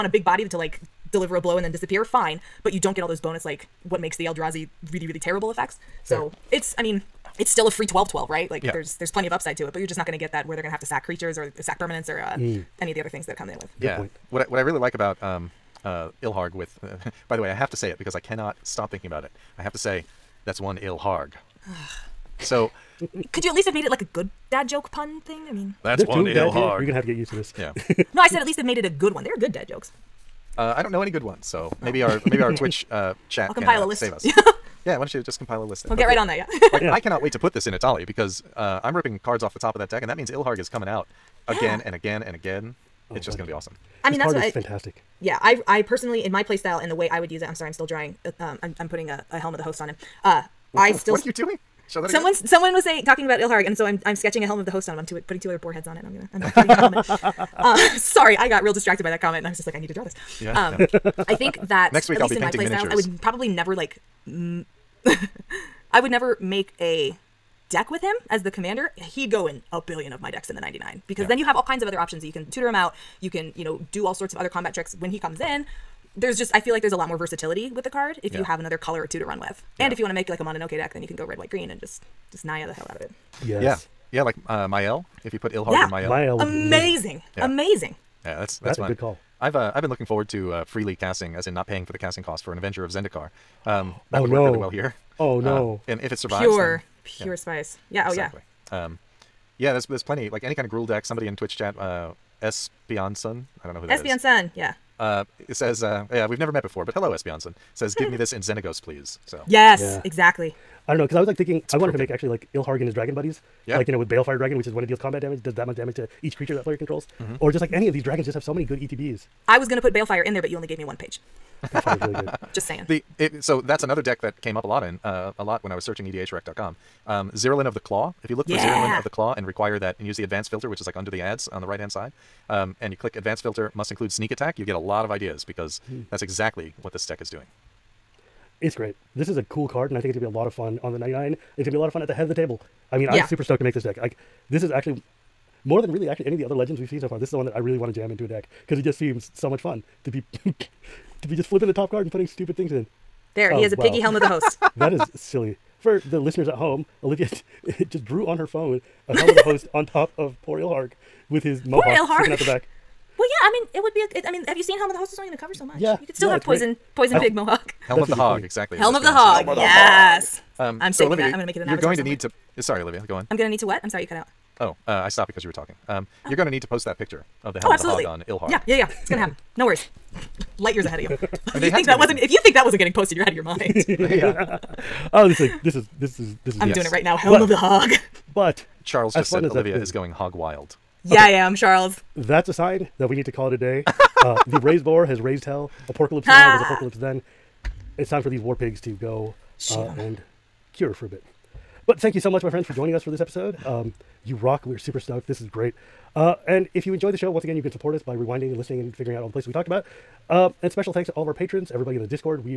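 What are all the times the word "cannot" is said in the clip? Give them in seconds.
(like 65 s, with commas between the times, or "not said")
18 s, 36 s.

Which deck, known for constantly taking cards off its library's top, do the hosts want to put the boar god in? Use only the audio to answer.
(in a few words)
Etali.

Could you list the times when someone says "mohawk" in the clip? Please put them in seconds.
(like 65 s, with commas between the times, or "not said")
161 s, 167 s.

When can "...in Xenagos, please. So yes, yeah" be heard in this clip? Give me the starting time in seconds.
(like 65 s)
108 s.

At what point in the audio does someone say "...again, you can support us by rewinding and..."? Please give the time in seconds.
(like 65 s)
207 s.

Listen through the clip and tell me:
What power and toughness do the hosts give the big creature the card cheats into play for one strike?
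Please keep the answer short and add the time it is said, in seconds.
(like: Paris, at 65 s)
12-12, at 7 s.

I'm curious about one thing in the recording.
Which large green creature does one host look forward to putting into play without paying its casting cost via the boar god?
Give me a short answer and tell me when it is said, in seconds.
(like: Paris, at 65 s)
Avenger of Zendikar, at 92 s.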